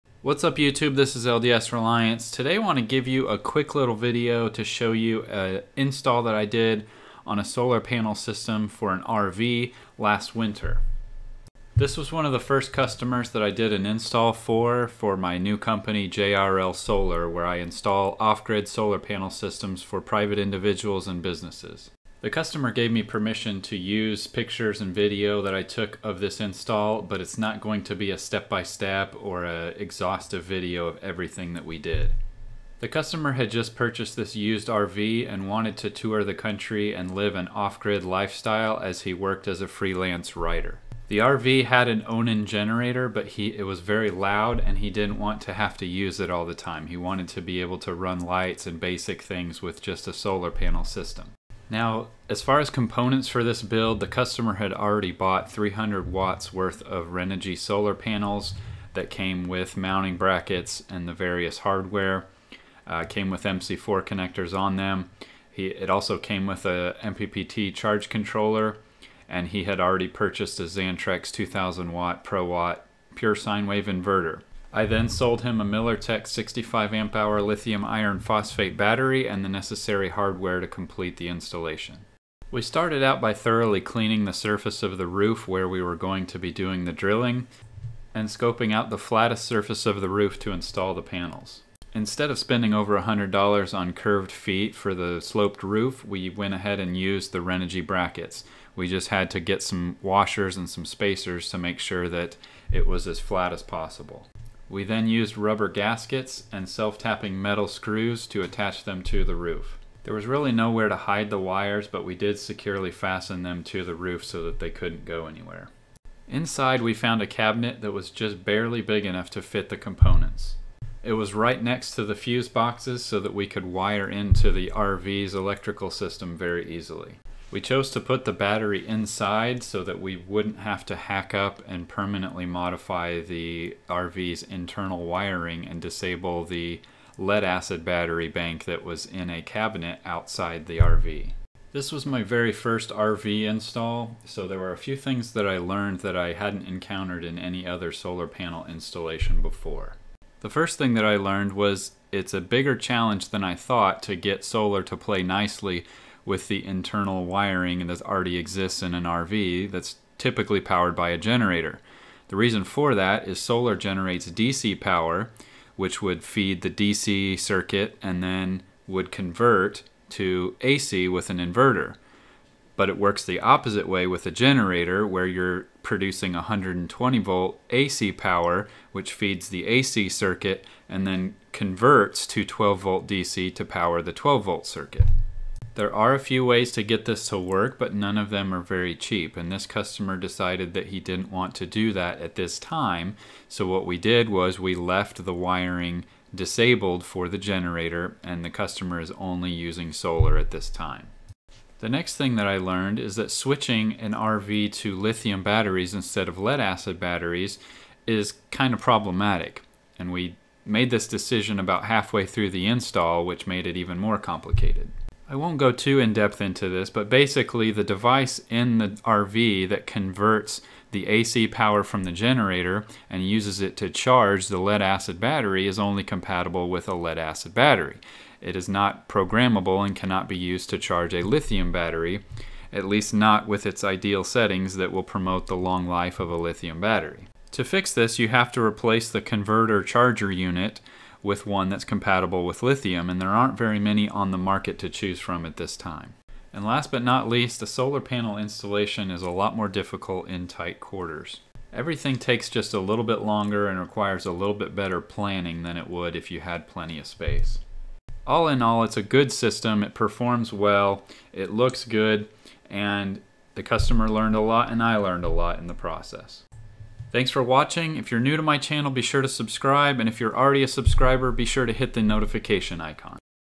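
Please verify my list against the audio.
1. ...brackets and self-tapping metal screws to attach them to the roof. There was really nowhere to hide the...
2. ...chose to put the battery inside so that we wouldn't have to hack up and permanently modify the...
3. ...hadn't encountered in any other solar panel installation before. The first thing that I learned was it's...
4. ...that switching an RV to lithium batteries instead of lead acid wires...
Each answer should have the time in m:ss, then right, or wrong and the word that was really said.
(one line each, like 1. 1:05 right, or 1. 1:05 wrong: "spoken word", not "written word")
1. 1:45 wrong: "gaskets", not "brackets"
2. 2:07 right
3. 2:26 right
4. 3:23 wrong: "batteries", not "wires".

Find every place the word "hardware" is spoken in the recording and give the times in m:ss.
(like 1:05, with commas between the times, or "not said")
1:01, 1:20.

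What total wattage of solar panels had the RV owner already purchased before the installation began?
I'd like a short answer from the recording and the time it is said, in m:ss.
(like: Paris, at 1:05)
300 watts, at 0:55.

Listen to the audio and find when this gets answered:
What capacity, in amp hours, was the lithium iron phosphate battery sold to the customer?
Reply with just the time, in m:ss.
1:16.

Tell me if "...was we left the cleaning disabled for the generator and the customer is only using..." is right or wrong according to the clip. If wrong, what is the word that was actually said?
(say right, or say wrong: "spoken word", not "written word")
wrong: "wiring", not "cleaning".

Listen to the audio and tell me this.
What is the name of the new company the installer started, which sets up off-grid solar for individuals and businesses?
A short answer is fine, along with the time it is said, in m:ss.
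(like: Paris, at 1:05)
JRL Solar, at 0:16.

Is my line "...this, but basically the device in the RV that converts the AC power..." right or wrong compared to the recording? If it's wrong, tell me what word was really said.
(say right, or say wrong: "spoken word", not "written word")
right.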